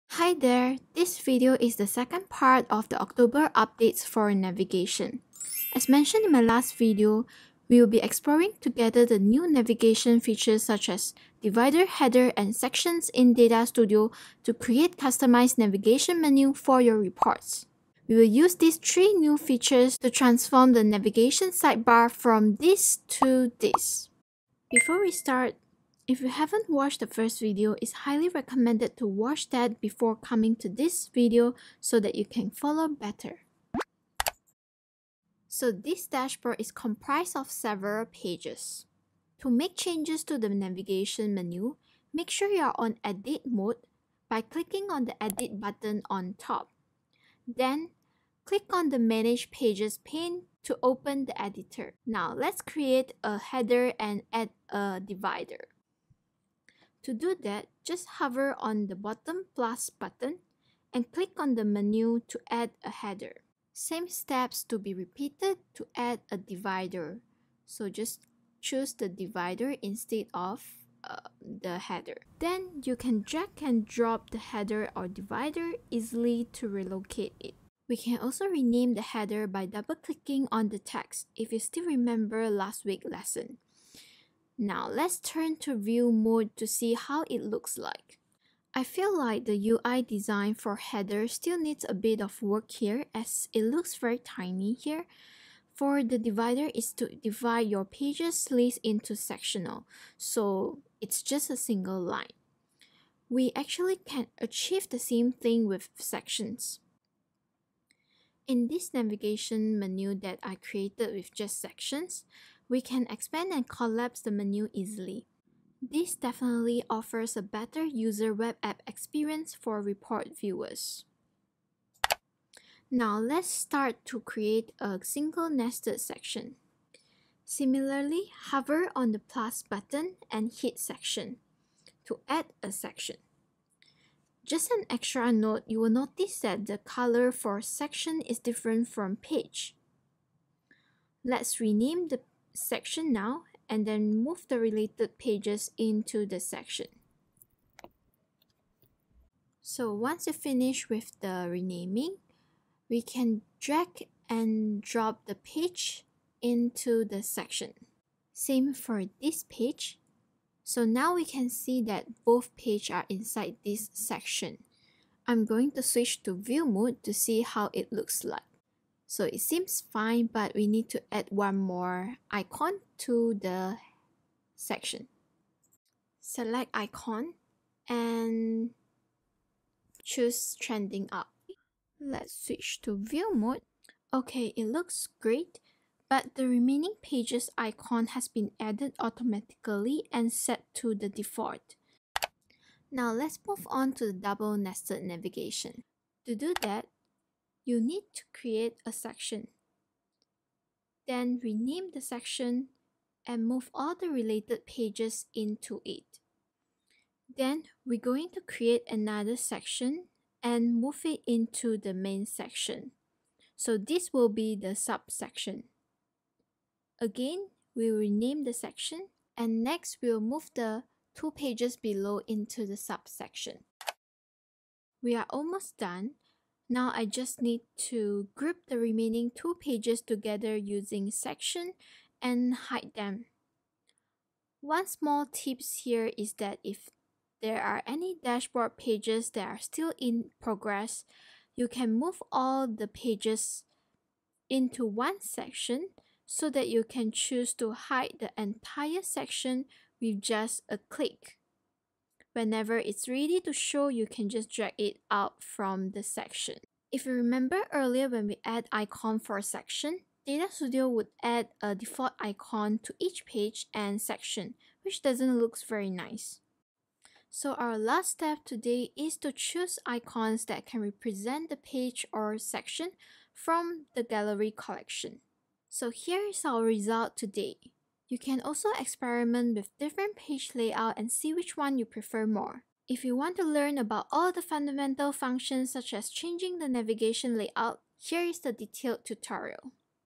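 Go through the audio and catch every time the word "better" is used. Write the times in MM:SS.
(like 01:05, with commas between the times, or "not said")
00:32, 01:57.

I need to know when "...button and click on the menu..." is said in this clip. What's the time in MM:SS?
00:59.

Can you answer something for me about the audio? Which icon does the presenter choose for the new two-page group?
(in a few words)
trending up.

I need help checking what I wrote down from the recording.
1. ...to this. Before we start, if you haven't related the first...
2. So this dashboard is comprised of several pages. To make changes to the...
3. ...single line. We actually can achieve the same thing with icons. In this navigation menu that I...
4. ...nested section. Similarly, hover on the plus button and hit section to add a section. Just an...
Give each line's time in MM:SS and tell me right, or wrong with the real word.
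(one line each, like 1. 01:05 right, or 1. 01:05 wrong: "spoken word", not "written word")
1. 00:23 wrong: "watched", not "related"
2. 00:35 right
3. 01:41 wrong: "sections", not "icons"
4. 02:05 right.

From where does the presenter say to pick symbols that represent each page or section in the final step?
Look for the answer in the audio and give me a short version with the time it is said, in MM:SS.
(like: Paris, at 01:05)
the gallery collection, at 04:34.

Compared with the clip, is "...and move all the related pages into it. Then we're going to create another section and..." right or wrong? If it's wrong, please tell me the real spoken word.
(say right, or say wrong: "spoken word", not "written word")
right.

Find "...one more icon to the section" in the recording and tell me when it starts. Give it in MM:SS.
02:51.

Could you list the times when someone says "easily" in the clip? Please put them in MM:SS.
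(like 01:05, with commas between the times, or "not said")
01:15, 01:54.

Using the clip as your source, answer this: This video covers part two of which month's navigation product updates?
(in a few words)
October.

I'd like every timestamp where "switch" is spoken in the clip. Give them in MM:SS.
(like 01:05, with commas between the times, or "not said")
02:45, 03:02.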